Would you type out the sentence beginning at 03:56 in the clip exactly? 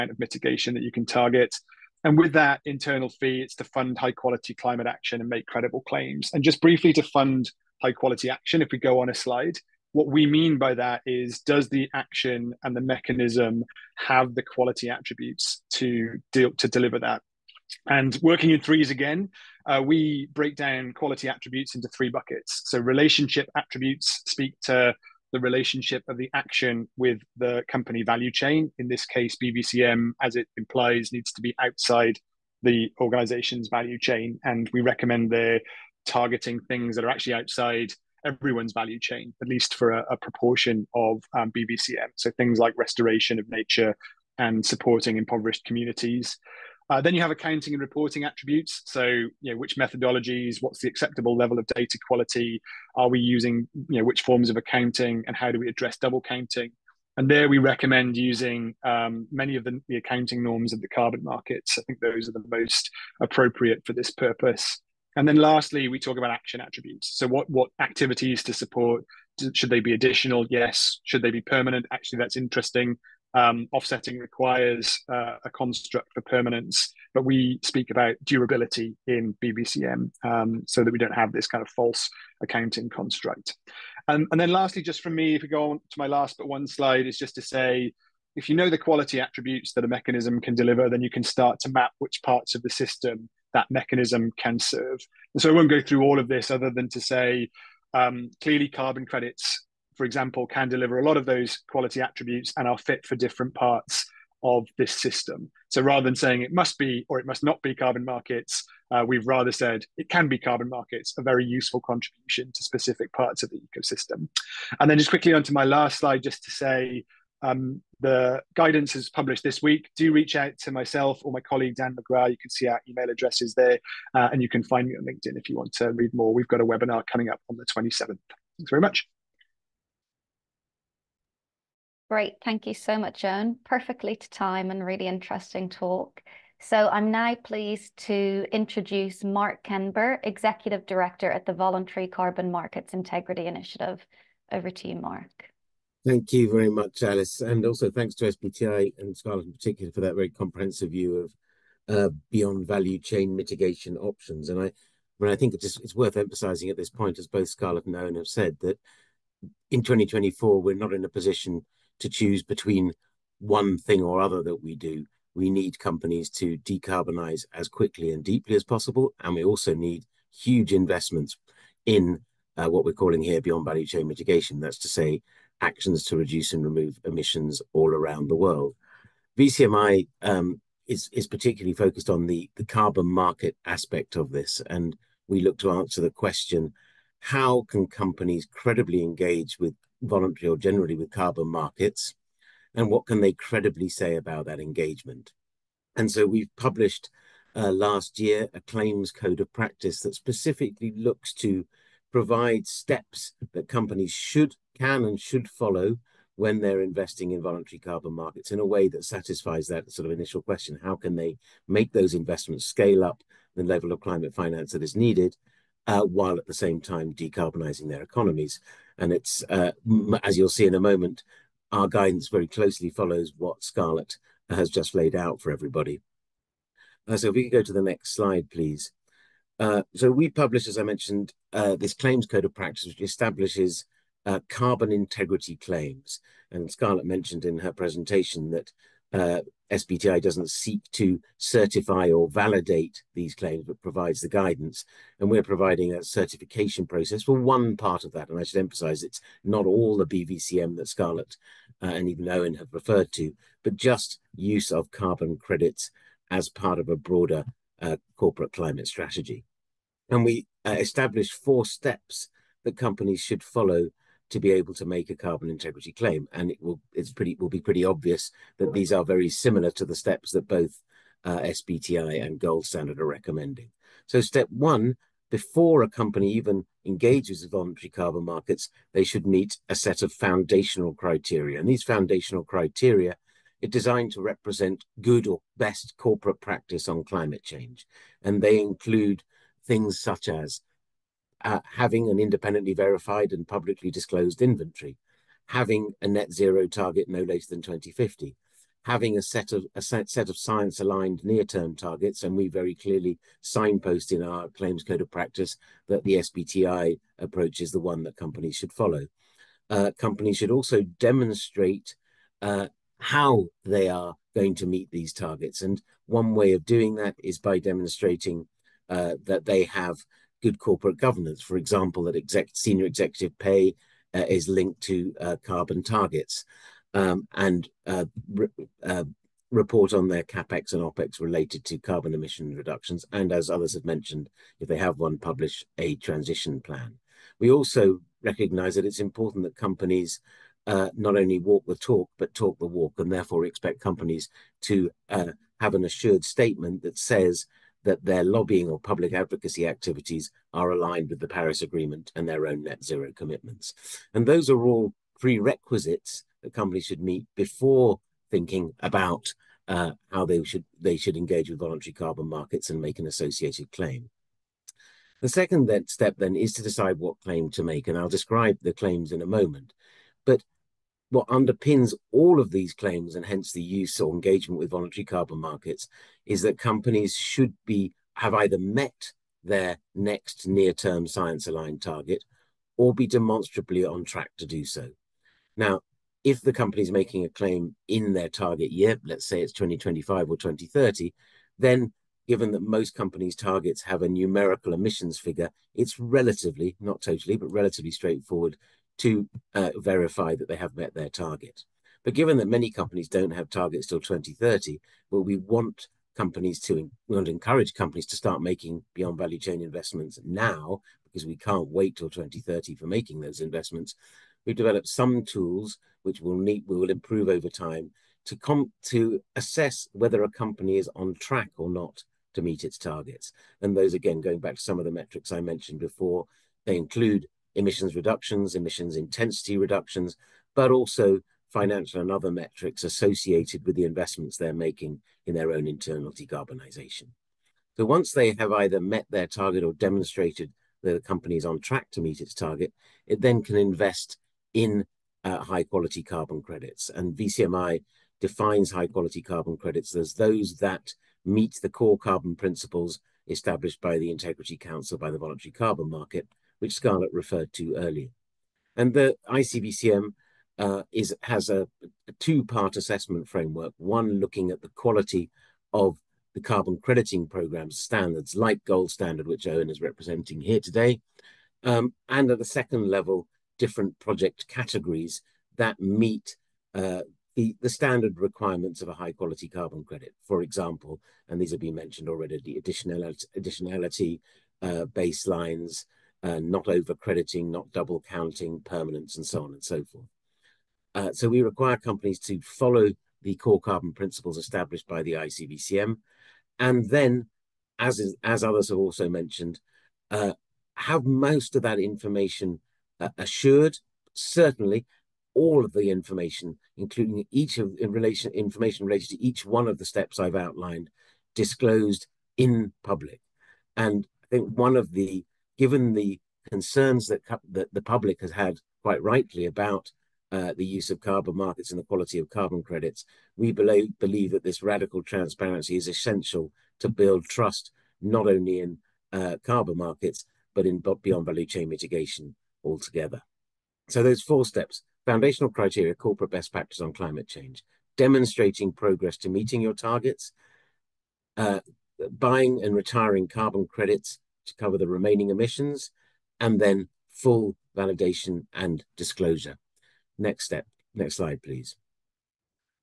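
And Scarlett mentioned in her presentation that uh, SBTI doesn't seek to certify or validate these claims, but provides the guidance.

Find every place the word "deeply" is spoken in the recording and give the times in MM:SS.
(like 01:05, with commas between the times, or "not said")
02:48.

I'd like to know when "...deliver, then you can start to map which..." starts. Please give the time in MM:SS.
01:30.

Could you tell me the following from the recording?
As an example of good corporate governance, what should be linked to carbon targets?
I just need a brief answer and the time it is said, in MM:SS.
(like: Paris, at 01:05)
senior executive pay, at 05:22.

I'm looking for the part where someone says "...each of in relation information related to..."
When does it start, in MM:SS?
08:27.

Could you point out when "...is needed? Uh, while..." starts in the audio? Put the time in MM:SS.
03:34.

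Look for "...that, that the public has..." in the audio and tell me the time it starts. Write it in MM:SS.
08:37.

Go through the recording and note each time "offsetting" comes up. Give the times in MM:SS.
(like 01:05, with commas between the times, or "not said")
01:13.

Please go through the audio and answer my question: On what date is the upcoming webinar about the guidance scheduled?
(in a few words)
27th.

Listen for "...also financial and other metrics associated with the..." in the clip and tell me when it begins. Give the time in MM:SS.
07:10.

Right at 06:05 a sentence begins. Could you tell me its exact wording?
The second then, step then is to decide what claim to make, and I'll describe the claims in a moment.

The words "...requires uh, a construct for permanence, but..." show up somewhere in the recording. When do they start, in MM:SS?
01:14.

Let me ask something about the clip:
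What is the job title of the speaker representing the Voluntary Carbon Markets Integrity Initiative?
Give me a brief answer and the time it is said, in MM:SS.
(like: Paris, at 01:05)
Executive Director, at 02:20.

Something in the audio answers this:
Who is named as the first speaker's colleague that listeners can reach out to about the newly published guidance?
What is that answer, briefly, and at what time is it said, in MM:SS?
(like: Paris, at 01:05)
Dan McGraw, at 02:01.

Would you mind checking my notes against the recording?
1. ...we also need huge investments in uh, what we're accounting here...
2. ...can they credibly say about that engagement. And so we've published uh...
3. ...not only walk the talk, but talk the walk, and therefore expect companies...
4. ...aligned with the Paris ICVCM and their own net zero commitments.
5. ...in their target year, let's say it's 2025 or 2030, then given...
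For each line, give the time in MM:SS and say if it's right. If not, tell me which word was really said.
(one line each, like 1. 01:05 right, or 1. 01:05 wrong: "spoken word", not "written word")
1. 02:49 wrong: "calling", not "accounting"
2. 03:13 right
3. 05:40 right
4. 05:50 wrong: "Agreement", not "ICVCM"
5. 06:27 right.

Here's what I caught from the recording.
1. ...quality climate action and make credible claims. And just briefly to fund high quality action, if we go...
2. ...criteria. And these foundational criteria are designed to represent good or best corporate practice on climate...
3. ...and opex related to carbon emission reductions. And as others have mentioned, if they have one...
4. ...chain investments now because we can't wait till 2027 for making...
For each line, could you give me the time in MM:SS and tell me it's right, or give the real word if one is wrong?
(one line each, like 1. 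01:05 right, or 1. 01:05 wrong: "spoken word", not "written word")
1. 00:04 right
2. 04:40 right
3. 05:30 right
4. 06:49 wrong: "2030", not "2027".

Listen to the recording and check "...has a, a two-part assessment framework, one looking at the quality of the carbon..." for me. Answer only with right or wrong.
right.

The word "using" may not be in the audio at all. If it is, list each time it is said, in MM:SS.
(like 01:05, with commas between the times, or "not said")
00:53, 00:58.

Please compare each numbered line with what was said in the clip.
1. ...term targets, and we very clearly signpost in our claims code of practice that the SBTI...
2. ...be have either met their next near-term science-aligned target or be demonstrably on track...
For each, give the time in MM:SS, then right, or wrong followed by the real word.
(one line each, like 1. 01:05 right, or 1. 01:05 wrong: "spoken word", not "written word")
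1. 05:01 right
2. 06:17 right.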